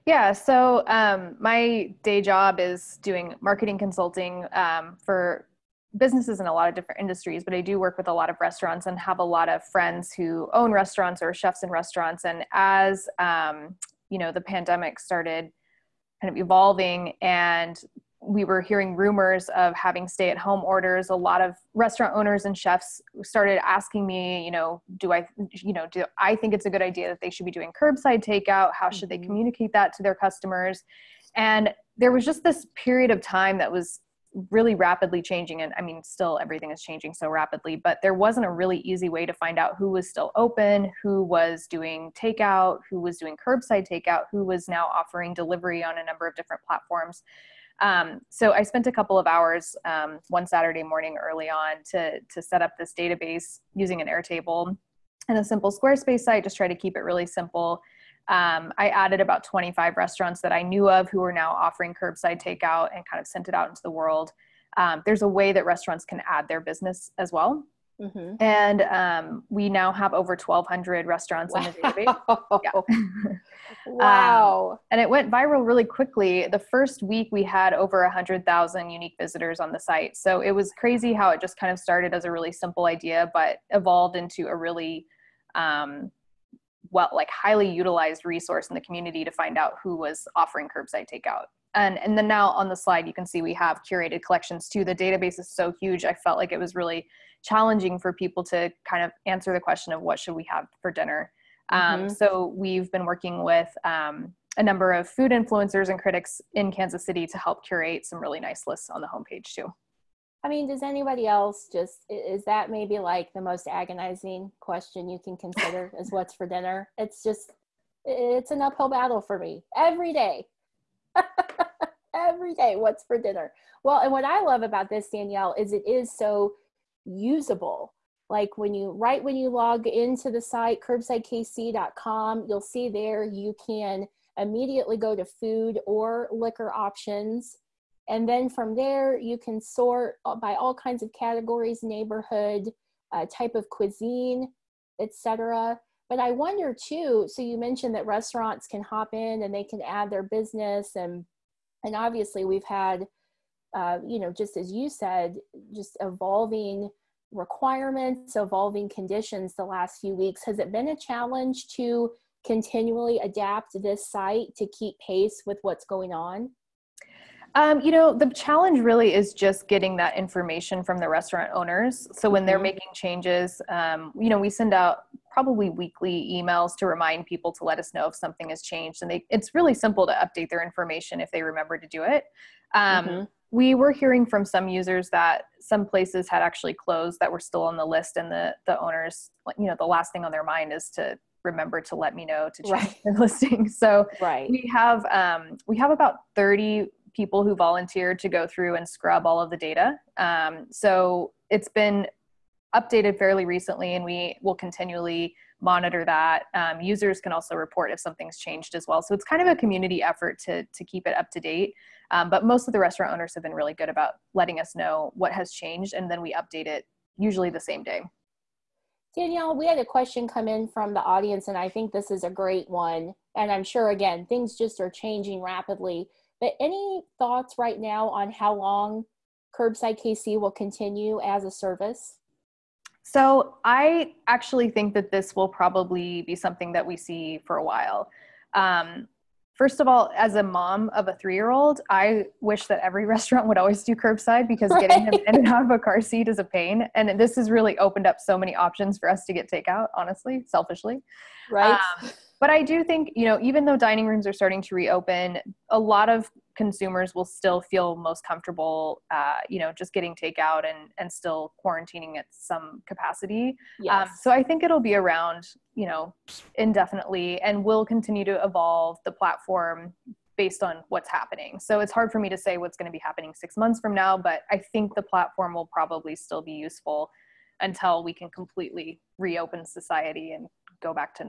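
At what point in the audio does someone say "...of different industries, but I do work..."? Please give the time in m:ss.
0:06.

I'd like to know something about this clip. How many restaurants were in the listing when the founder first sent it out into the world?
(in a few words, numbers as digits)
25.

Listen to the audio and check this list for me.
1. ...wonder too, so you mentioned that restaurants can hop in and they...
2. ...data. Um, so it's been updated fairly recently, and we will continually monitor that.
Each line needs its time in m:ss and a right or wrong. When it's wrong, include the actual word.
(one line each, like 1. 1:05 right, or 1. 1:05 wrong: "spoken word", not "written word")
1. 2:26 right
2. 3:19 right.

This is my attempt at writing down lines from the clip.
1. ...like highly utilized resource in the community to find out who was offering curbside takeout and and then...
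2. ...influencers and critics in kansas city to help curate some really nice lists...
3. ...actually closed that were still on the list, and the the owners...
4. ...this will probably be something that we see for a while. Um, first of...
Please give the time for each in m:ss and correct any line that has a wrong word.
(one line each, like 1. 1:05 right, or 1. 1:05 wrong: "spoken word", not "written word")
1. 1:27 right
2. 1:45 right
3. 3:06 right
4. 3:55 right.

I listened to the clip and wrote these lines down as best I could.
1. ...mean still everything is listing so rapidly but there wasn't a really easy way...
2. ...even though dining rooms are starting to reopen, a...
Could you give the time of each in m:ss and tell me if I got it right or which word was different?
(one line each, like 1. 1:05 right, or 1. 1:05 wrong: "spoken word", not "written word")
1. 0:35 wrong: "changing", not "listing"
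2. 4:13 right.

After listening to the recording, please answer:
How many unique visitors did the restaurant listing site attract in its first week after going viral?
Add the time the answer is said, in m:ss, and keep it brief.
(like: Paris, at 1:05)
over 100,000, at 1:17.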